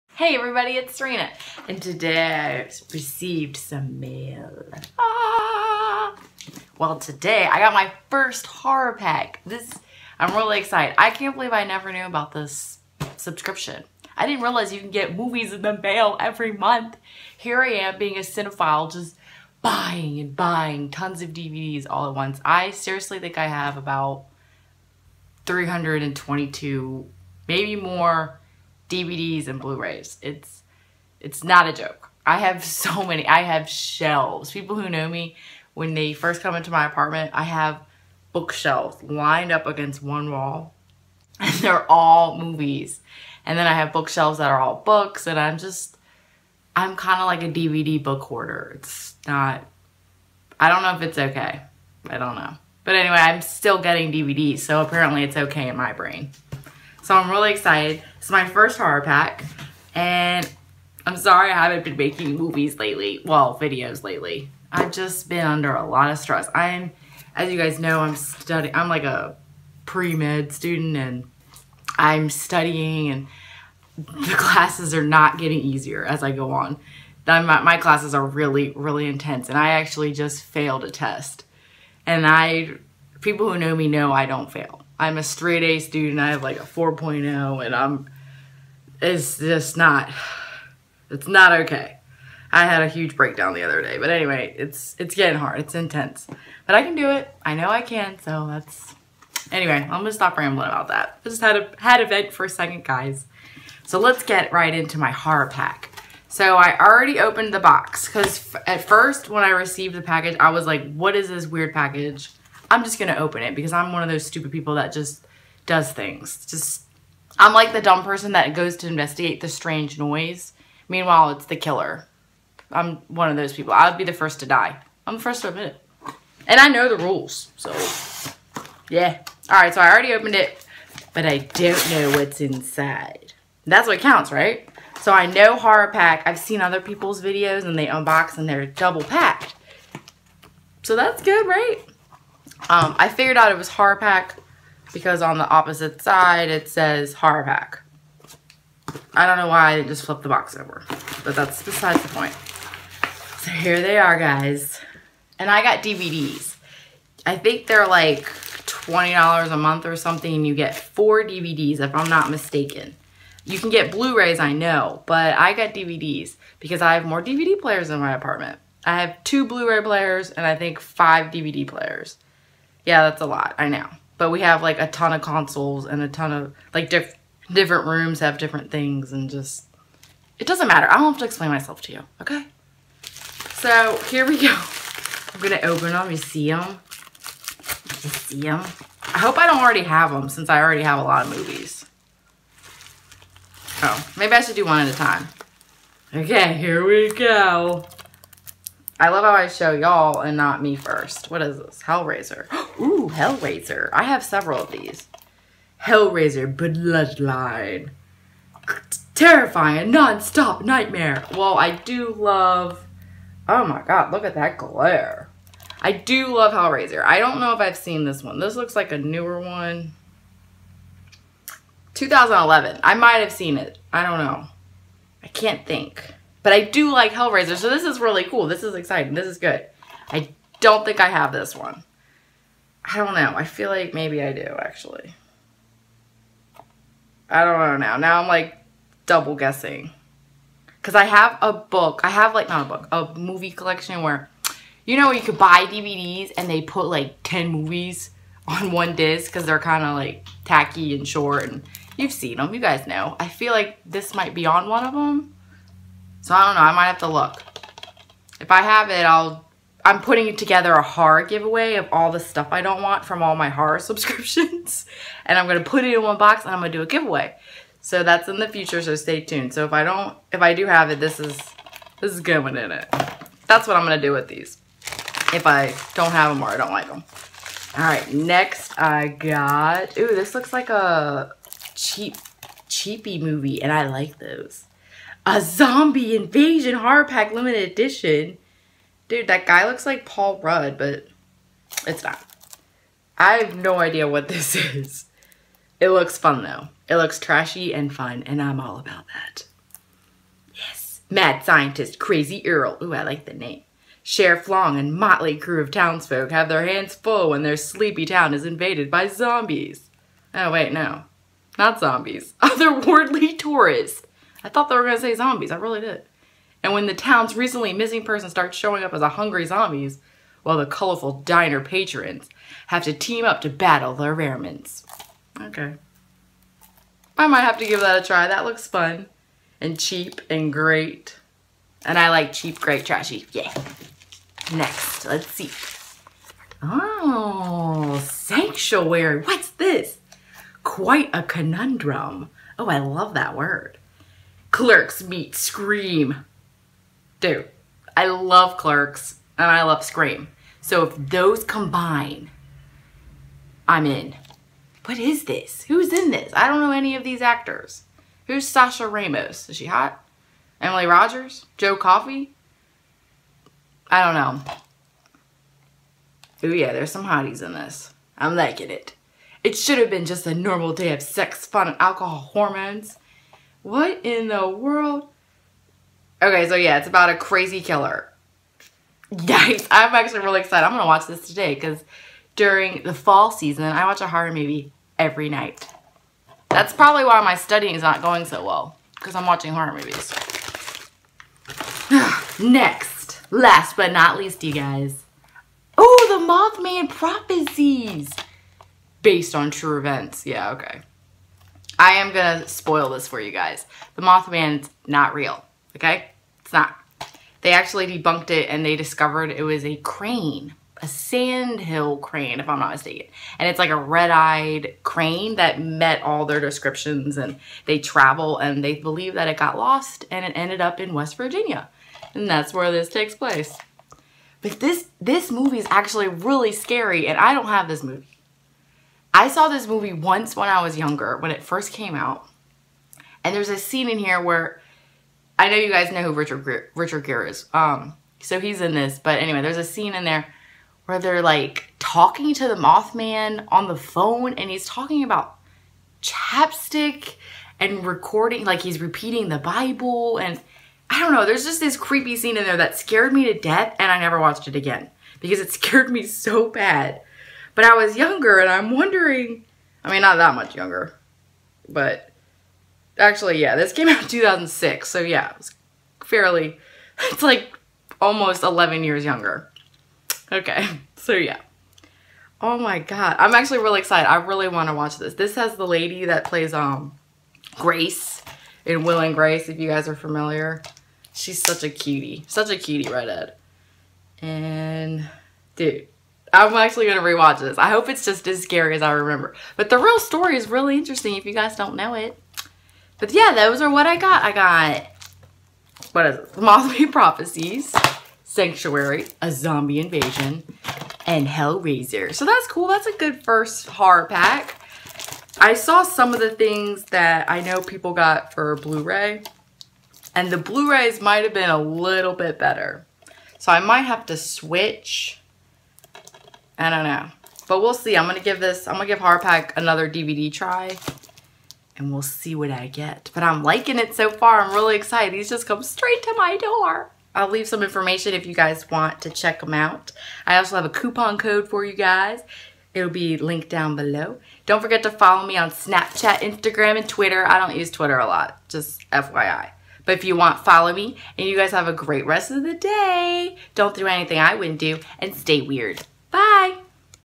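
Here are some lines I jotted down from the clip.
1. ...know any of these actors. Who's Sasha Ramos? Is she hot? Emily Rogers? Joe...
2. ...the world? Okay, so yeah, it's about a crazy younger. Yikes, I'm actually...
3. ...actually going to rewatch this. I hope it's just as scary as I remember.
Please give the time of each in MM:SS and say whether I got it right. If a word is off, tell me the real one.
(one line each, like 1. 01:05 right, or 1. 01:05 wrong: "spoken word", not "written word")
1. 05:56 right
2. 06:14 wrong: "killer", not "younger"
3. 08:06 right.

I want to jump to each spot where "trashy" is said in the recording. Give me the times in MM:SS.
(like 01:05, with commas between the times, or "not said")
04:57, 05:32.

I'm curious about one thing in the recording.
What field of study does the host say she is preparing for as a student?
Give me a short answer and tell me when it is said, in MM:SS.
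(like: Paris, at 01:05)
Pre-med, at 01:09.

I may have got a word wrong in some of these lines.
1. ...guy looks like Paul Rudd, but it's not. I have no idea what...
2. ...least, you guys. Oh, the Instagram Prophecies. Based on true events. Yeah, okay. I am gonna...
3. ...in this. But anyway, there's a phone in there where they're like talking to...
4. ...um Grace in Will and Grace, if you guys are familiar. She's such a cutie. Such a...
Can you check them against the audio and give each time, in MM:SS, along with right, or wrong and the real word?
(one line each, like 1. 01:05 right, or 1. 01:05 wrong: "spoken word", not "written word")
1. 04:49 right
2. 06:34 wrong: "Mothman", not "Instagram"
3. 07:18 wrong: "scene", not "phone"
4. 07:56 right.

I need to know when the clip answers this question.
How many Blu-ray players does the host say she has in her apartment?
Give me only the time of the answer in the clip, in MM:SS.
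02:49.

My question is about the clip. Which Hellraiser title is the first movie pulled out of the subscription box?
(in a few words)
Hellraiser Bloodline.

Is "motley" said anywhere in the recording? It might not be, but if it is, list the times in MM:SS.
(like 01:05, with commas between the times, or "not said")
05:04.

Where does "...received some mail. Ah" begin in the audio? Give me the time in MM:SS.
00:02.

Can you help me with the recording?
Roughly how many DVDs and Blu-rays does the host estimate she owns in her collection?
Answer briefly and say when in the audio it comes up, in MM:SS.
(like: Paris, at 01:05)
322, at 00:25.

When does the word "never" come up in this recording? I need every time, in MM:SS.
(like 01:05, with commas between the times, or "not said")
00:11, 07:33.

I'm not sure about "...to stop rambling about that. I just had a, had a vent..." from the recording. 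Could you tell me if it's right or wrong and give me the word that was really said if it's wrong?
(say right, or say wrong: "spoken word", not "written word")
right.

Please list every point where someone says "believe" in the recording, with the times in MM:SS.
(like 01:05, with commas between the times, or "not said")
00:11, 06:58.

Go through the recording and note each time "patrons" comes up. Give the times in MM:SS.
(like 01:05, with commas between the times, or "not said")
05:21.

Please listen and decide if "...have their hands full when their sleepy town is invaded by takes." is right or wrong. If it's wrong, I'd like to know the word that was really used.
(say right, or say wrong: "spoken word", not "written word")
wrong: "zombies", not "takes".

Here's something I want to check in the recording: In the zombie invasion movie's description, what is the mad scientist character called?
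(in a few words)
Crazy Earl.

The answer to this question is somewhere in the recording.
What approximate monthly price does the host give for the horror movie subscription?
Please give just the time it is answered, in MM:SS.
02:38.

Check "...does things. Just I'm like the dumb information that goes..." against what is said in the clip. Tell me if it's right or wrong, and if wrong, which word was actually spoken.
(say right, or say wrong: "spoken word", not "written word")
wrong: "person", not "information".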